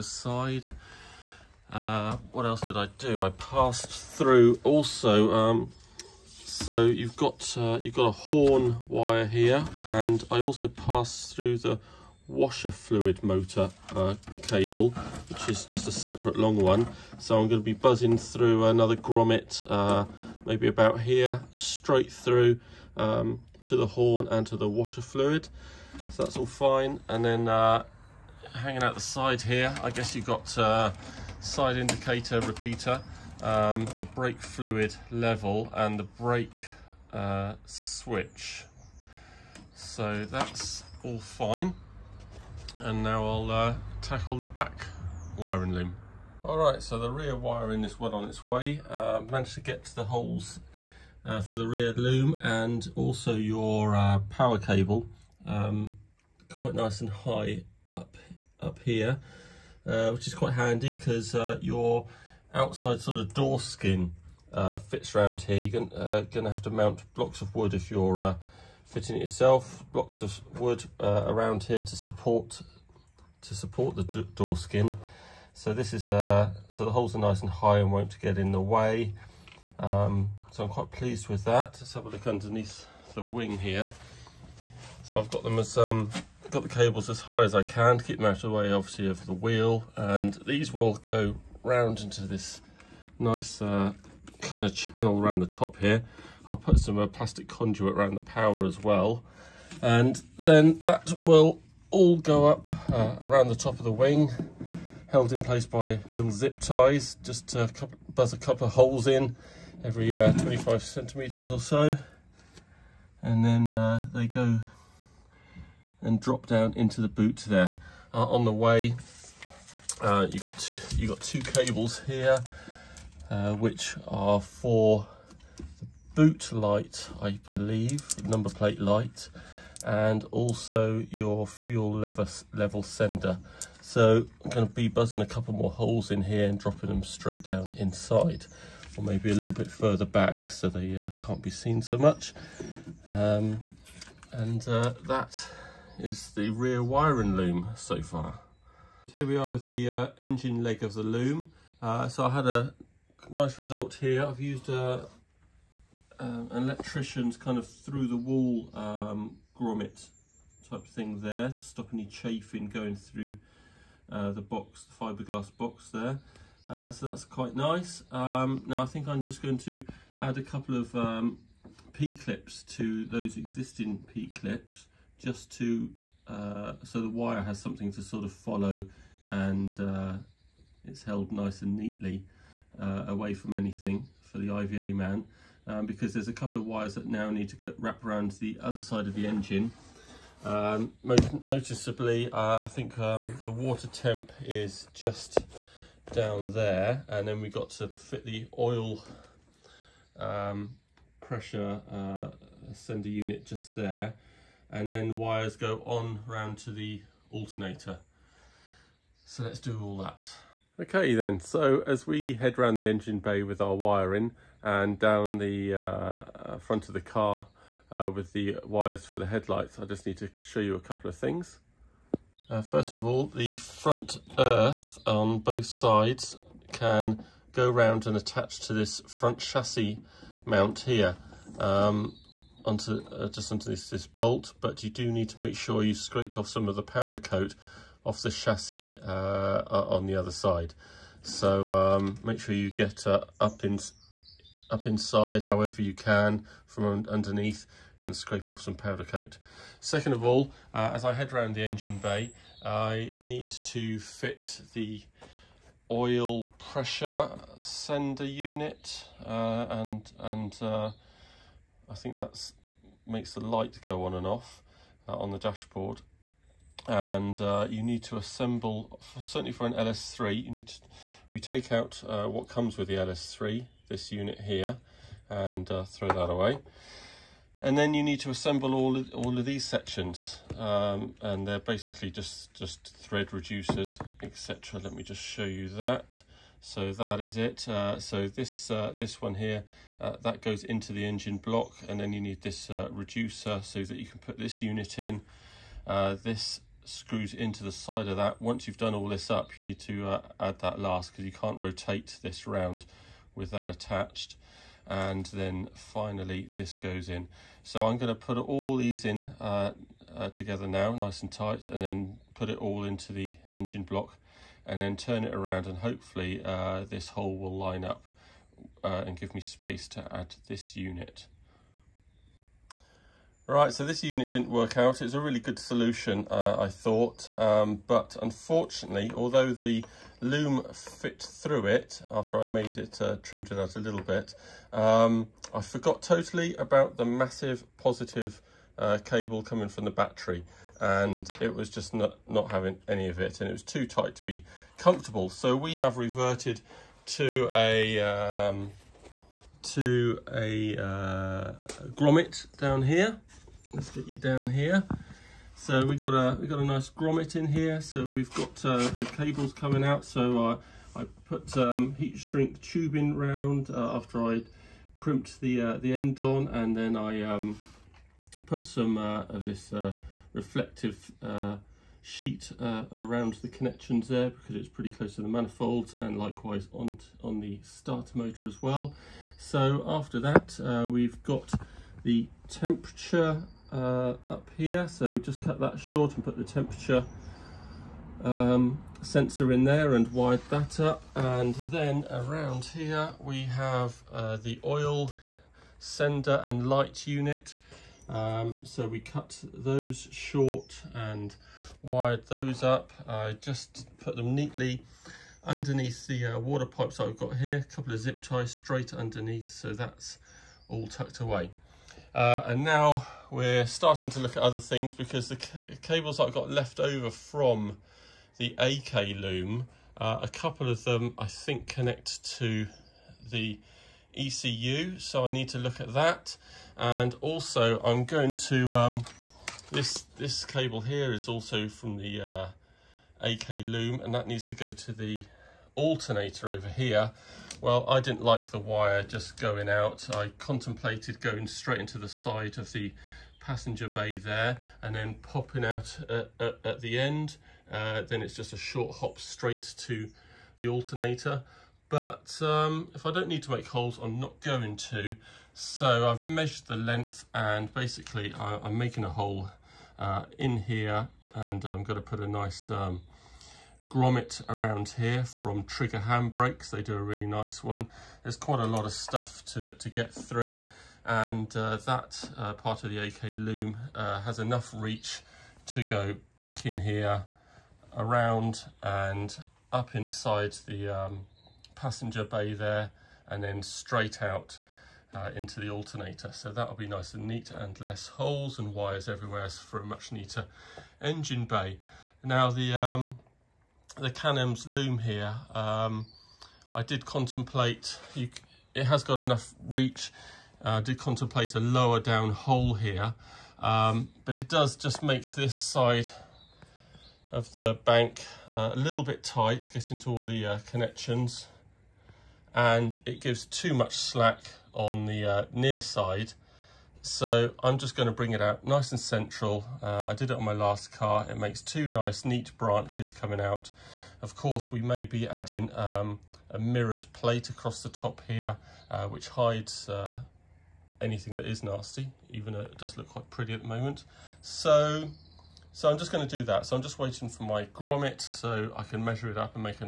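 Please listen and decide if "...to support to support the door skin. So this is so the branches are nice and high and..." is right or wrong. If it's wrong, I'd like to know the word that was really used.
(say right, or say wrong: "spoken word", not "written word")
wrong: "holes", not "branches".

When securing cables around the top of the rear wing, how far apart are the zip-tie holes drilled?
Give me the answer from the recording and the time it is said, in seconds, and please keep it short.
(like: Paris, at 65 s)
25 centimetres, at 110 s.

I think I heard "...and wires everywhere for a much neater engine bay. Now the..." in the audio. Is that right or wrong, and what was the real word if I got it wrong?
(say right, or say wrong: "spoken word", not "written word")
right.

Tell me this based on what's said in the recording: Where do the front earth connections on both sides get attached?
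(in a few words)
Front chassis mount.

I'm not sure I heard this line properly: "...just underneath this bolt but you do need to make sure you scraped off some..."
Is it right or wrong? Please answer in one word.
right.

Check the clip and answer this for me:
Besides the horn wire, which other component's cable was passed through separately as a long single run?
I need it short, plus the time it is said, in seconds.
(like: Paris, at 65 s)
Washer fluid motor, at 12 s.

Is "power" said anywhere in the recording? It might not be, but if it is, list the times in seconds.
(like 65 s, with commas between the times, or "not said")
54 s, 98 s.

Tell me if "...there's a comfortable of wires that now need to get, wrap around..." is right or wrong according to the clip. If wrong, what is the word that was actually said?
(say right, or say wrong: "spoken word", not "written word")
wrong: "couple", not "comfortable".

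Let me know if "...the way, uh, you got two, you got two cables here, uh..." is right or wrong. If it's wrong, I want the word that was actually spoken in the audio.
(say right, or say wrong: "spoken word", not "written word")
right.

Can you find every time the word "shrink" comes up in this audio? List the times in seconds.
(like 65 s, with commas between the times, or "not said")
362 s.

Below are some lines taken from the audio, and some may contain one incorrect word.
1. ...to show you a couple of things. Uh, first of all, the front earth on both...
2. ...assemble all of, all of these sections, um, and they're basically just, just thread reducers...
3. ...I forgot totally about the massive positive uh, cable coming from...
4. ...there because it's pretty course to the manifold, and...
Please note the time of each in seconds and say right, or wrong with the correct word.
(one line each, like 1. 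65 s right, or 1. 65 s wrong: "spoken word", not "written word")
1. 220 s right
2. 278 s right
3. 335 s right
4. 374 s wrong: "close", not "course".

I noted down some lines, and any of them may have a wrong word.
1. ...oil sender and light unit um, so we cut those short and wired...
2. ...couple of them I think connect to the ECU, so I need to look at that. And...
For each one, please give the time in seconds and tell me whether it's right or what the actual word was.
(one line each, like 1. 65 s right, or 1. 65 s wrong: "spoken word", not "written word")
1. 394 s right
2. 420 s right.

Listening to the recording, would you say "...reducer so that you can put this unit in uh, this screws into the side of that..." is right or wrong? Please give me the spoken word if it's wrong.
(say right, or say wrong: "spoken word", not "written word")
right.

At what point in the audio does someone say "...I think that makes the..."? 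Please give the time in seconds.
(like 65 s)
261 s.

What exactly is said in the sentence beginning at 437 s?
Well, I didn't like the wire just going out.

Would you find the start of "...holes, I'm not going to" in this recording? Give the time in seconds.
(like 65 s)
453 s.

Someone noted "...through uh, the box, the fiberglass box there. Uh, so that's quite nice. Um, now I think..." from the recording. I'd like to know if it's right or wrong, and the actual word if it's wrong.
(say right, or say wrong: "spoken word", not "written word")
right.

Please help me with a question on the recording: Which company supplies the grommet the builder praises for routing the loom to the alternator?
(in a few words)
Trigger Handbrakes.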